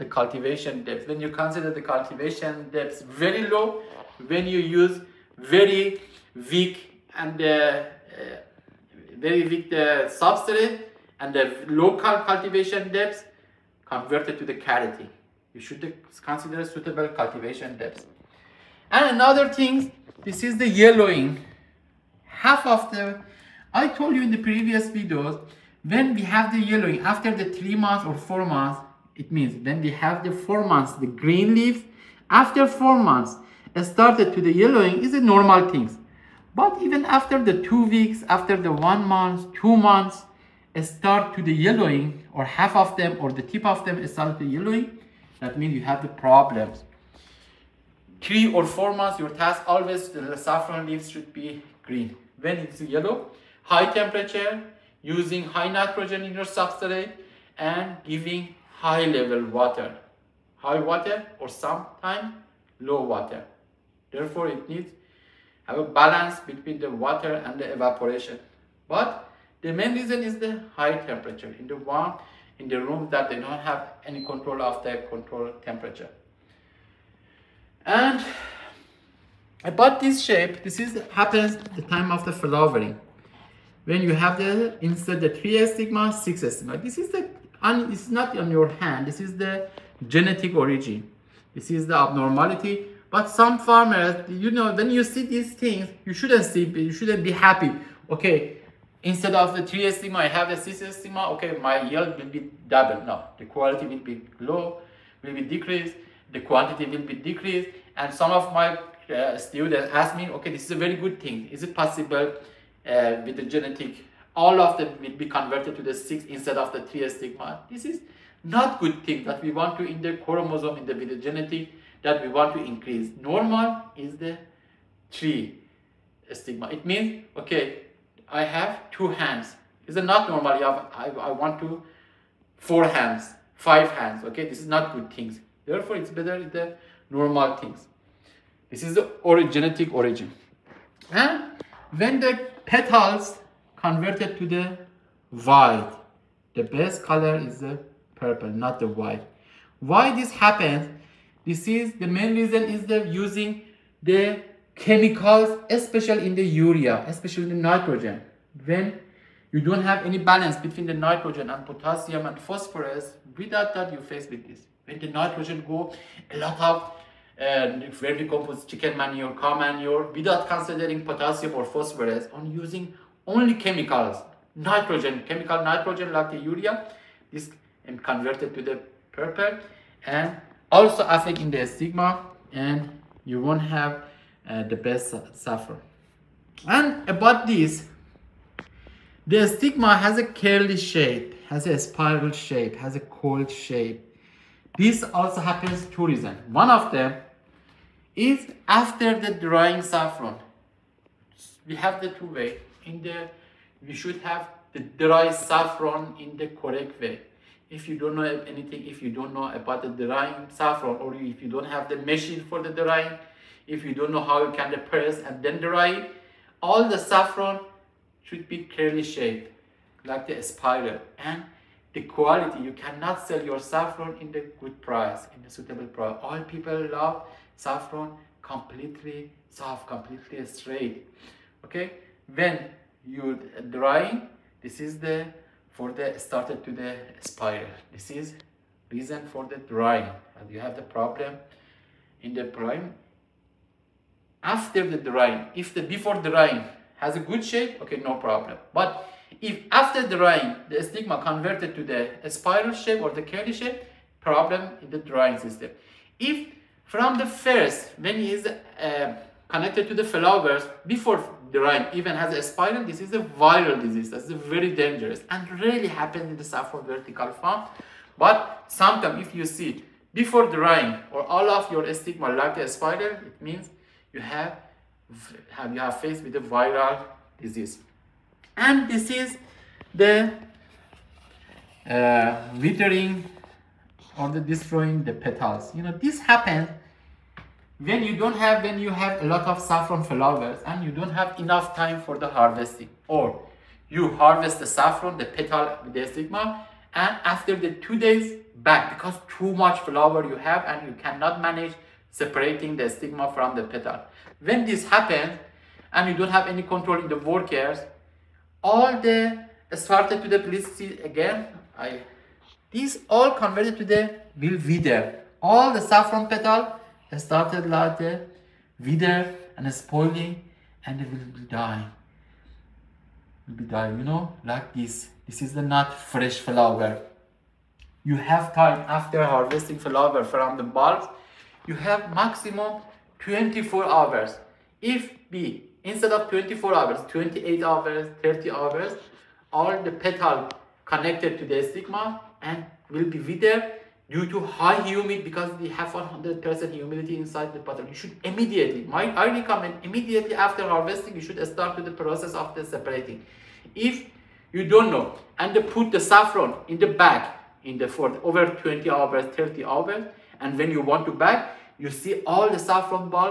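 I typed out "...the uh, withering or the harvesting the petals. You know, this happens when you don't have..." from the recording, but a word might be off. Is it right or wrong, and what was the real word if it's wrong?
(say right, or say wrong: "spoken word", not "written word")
wrong: "destroying", not "harvesting".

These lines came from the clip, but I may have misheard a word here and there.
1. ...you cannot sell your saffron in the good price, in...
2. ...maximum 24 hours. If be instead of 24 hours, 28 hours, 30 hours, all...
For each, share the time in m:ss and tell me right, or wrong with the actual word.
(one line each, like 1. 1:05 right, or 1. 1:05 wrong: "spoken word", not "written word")
1. 3:42 right
2. 5:32 right.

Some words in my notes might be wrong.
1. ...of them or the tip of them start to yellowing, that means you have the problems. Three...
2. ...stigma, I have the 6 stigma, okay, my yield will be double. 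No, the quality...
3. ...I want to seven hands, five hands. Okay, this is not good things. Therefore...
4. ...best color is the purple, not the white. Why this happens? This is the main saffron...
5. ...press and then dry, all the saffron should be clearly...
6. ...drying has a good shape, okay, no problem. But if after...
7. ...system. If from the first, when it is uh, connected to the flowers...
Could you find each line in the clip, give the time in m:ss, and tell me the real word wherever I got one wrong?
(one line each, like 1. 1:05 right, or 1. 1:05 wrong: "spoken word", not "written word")
1. 0:42 right
2. 1:39 right
3. 2:11 wrong: "four", not "seven"
4. 2:26 wrong: "reason", not "saffron"
5. 3:34 right
6. 4:06 right
7. 4:15 right.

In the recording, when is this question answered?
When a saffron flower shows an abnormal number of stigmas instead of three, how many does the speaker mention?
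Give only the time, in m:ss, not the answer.
1:26.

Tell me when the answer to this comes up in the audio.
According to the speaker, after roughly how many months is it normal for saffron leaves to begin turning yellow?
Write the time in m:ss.
0:32.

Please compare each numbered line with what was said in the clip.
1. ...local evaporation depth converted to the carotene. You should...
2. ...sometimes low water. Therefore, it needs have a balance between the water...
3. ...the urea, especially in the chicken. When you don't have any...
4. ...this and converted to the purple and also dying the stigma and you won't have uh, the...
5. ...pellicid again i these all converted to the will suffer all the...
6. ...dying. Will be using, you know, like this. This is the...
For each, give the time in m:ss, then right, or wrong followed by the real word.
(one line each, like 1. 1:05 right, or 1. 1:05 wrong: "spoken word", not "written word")
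1. 0:11 wrong: "cultivation", not "evaporation"
2. 1:01 right
3. 2:36 wrong: "nitrogen", not "chicken"
4. 2:57 wrong: "affecting", not "dying"
5. 5:10 wrong: "wither", not "suffer"
6. 5:21 wrong: "dying", not "using".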